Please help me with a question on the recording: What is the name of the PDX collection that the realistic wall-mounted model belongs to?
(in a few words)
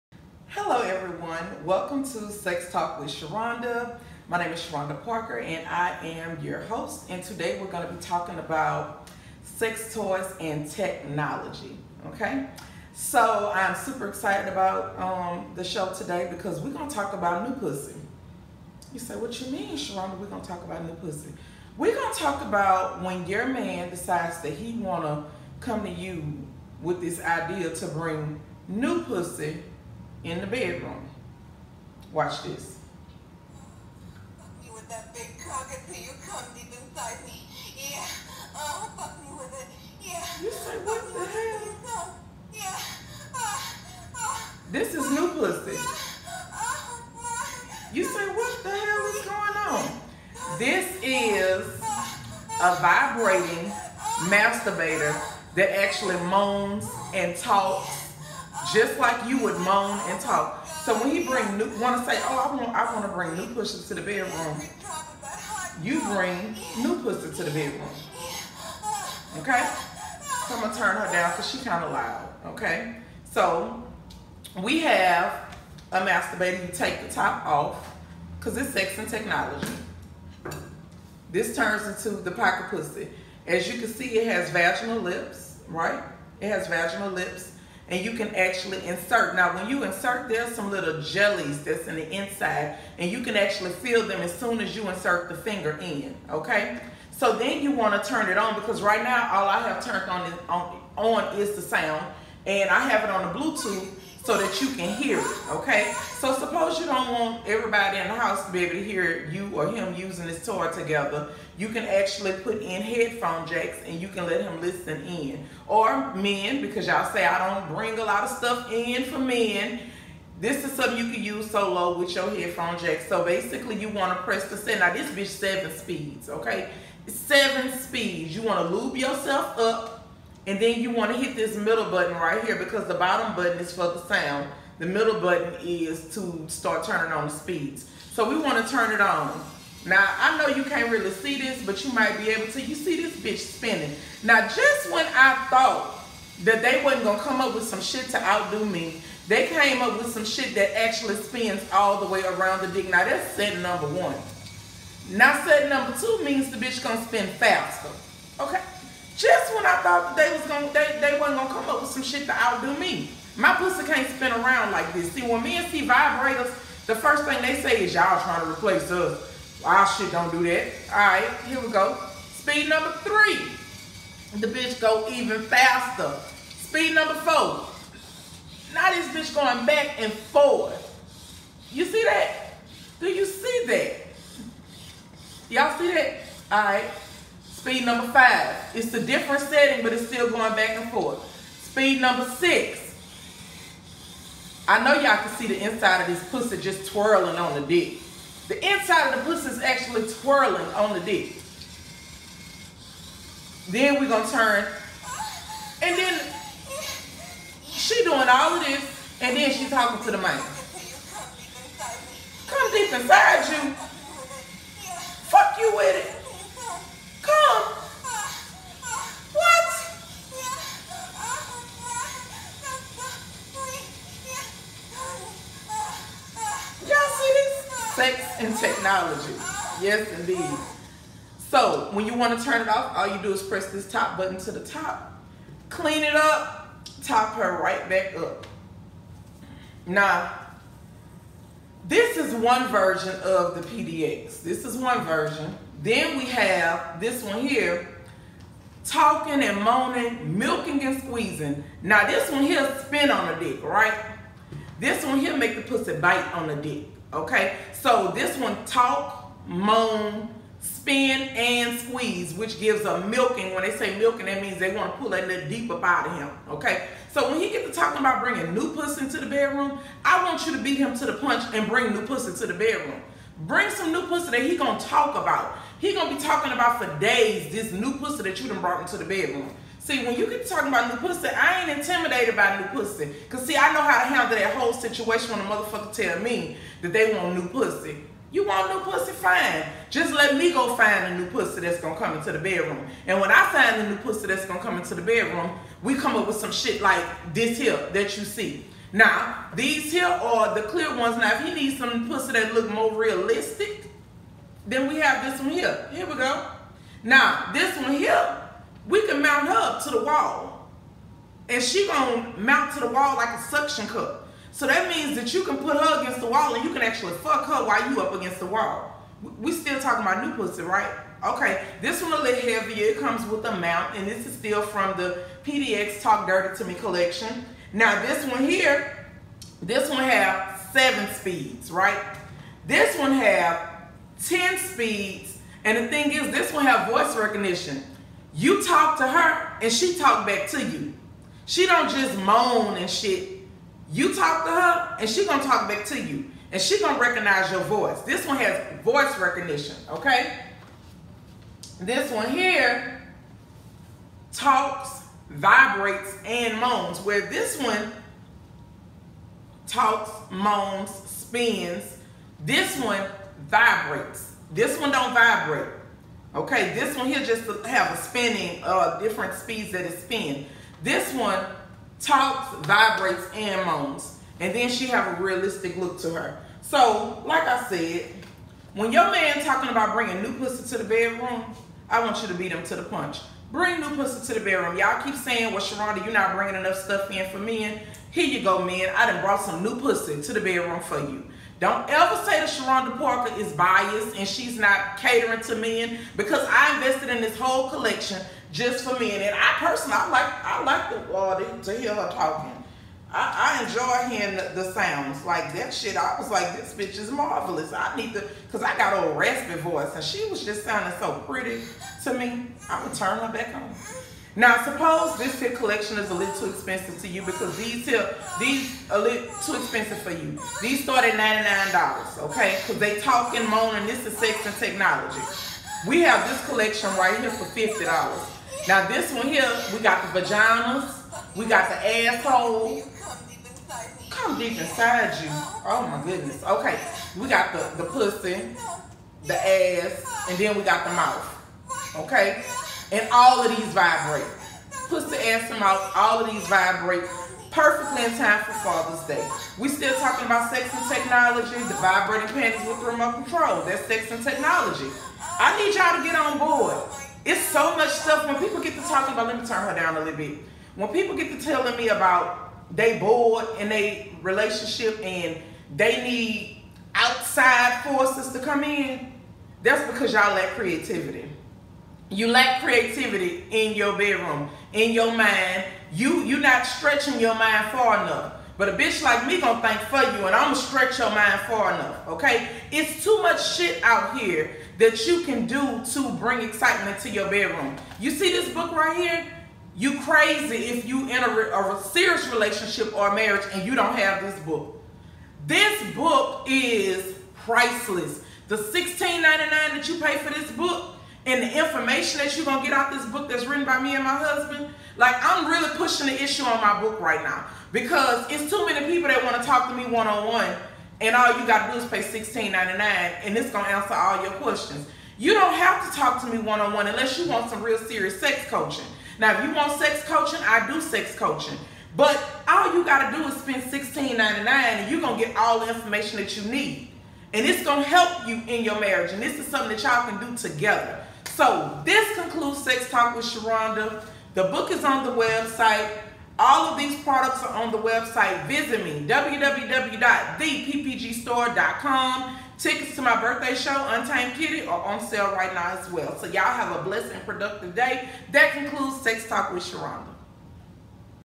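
Talk Dirty to Me.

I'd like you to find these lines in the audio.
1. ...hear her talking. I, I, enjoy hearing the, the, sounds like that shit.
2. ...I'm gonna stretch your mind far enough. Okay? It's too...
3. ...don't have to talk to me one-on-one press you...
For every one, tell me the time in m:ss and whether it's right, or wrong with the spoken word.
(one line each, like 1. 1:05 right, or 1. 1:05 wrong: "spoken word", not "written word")
1. 6:41 right
2. 8:00 right
3. 8:35 wrong: "unless", not "press".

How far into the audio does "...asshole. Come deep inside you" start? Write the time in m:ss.
7:12.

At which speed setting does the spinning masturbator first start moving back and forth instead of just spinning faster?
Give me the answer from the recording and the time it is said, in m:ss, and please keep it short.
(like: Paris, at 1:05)
4, at 2:57.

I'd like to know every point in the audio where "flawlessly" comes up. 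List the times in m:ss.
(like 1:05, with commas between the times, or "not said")
not said.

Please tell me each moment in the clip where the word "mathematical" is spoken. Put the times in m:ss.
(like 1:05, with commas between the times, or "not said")
not said.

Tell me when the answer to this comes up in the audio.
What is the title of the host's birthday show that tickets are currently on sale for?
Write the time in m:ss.
9:03.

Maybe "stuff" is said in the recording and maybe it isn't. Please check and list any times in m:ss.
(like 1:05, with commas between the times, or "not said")
1:58, 6:26, 7:37.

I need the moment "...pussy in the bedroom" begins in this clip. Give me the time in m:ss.
0:29.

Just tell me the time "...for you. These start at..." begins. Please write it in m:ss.
7:00.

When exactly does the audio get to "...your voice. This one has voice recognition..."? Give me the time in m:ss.
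5:47.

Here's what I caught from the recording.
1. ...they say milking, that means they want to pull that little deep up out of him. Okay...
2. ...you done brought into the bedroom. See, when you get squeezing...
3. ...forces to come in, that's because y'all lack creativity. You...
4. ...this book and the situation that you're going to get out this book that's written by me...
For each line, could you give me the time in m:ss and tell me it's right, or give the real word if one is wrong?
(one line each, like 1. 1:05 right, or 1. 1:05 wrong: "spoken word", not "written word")
1. 4:23 right
2. 4:38 wrong: "talking", not "squeezing"
3. 7:47 right
4. 8:20 wrong: "information", not "situation".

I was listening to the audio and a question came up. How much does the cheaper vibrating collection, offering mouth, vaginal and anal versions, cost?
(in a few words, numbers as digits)
$50.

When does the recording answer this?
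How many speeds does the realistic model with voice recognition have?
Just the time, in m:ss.
5:34.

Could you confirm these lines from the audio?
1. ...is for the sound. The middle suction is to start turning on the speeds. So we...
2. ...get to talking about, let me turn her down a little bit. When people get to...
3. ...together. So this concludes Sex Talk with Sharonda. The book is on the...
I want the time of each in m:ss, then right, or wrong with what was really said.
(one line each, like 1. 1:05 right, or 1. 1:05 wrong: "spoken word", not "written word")
1. 2:13 wrong: "button", not "suction"
2. 7:38 right
3. 8:50 right.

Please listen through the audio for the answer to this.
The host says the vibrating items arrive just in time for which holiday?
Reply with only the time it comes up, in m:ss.
7:28.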